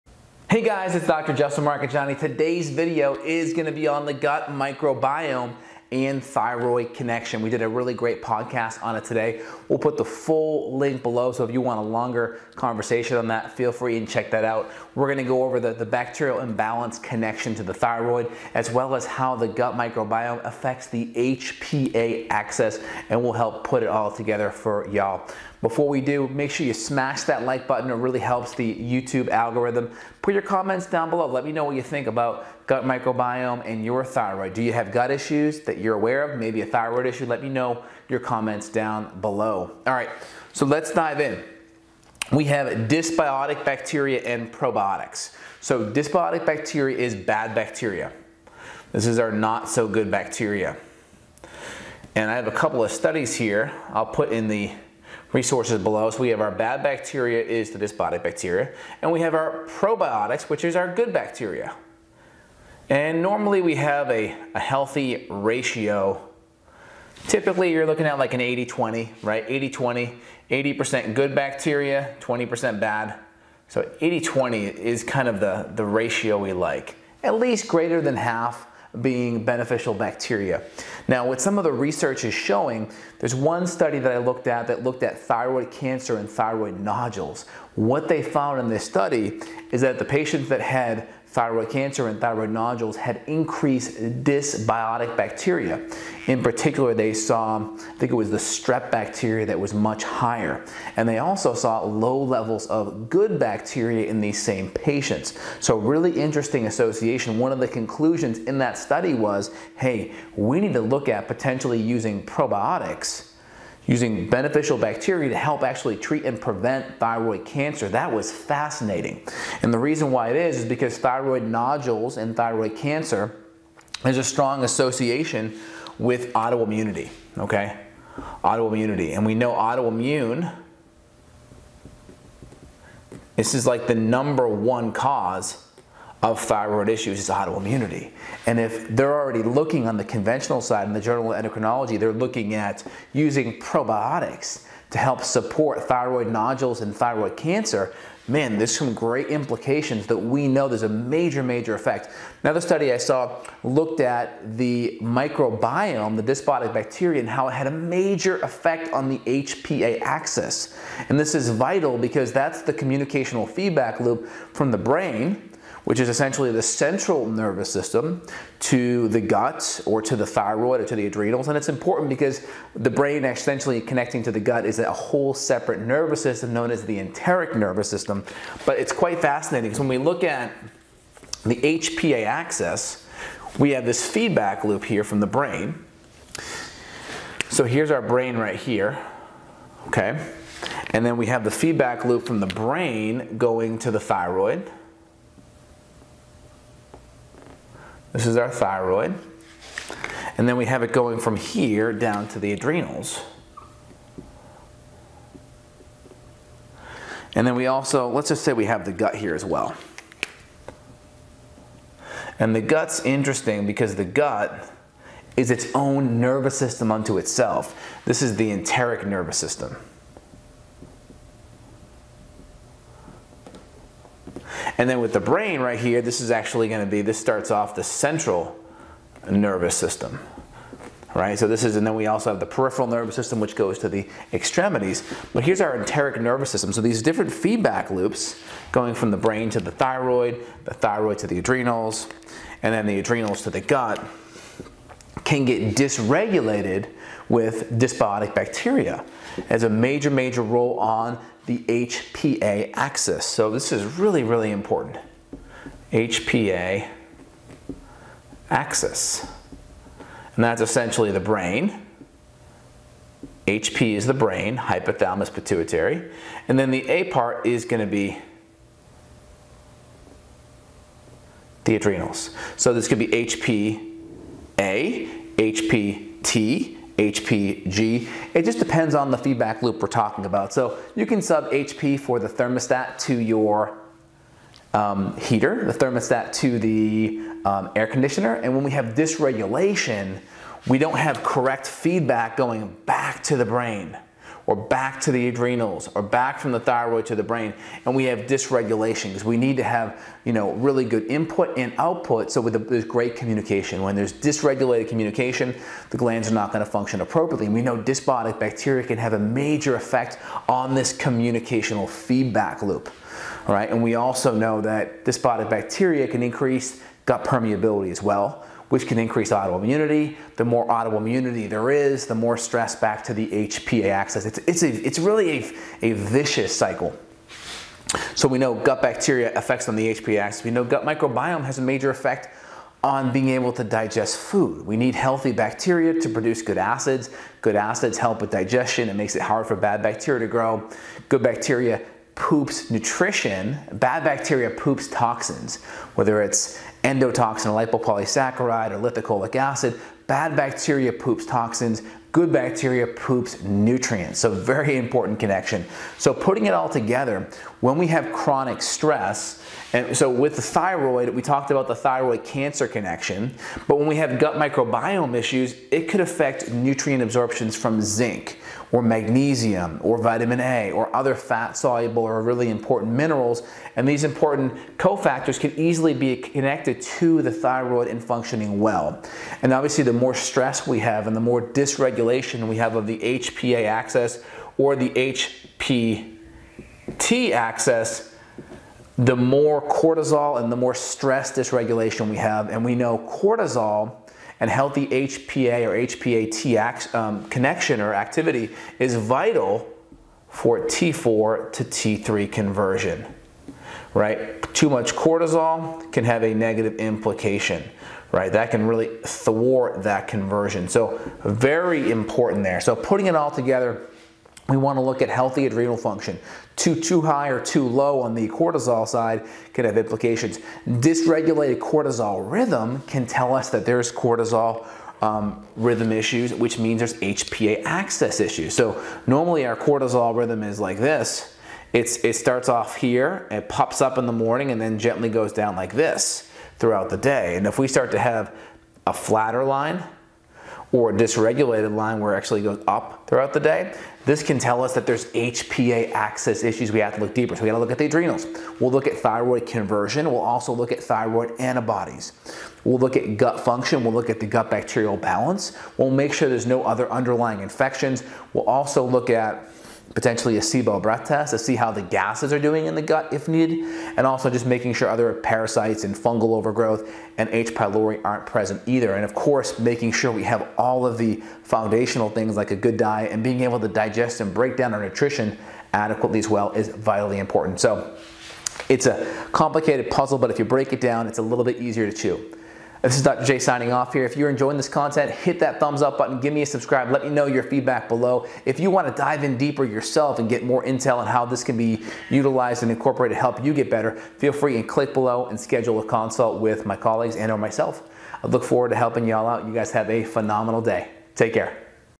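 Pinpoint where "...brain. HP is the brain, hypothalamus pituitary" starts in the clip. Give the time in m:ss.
4:21.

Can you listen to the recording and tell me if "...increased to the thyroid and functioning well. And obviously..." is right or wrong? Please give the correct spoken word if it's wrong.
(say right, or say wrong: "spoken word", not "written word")
wrong: "connected", not "increased".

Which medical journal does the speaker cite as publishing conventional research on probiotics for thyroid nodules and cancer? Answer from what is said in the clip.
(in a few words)
Journal of Endocrinology.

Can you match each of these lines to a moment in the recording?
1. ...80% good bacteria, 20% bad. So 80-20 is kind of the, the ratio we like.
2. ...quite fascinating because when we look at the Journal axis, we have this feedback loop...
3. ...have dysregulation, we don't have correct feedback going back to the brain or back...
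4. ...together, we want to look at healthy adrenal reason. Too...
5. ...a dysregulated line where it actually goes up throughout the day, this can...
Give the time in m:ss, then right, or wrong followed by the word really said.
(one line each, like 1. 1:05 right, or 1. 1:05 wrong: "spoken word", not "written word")
1. 1:10 right
2. 2:58 wrong: "HPA", not "Journal"
3. 4:48 right
4. 6:53 wrong: "function", not "reason"
5. 7:20 right.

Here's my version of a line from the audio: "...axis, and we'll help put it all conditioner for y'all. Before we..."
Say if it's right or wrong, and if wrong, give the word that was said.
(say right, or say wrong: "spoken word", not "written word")
wrong: "together", not "conditioner".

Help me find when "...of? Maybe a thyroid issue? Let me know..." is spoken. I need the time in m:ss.
0:36.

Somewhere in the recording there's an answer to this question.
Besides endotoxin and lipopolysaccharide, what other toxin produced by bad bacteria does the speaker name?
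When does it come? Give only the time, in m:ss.
5:48.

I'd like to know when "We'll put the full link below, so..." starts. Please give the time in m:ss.
0:09.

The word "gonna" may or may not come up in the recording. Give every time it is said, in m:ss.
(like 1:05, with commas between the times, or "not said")
0:03, 0:15.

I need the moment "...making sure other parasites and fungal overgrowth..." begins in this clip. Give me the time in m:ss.
7:44.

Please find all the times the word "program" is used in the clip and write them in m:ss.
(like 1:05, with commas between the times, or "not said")
not said.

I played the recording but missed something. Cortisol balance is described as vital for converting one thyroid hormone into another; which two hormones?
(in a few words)
T4 to T3.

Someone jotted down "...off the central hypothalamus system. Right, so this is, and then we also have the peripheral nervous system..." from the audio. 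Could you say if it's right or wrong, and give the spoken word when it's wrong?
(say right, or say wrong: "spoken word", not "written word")
wrong: "nervous", not "hypothalamus".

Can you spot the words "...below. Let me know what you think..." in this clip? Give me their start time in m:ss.
0:31.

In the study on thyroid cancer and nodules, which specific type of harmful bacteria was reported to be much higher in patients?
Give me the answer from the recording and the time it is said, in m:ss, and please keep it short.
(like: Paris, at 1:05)
strep, at 1:38.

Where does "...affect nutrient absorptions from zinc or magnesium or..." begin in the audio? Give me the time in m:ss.
6:06.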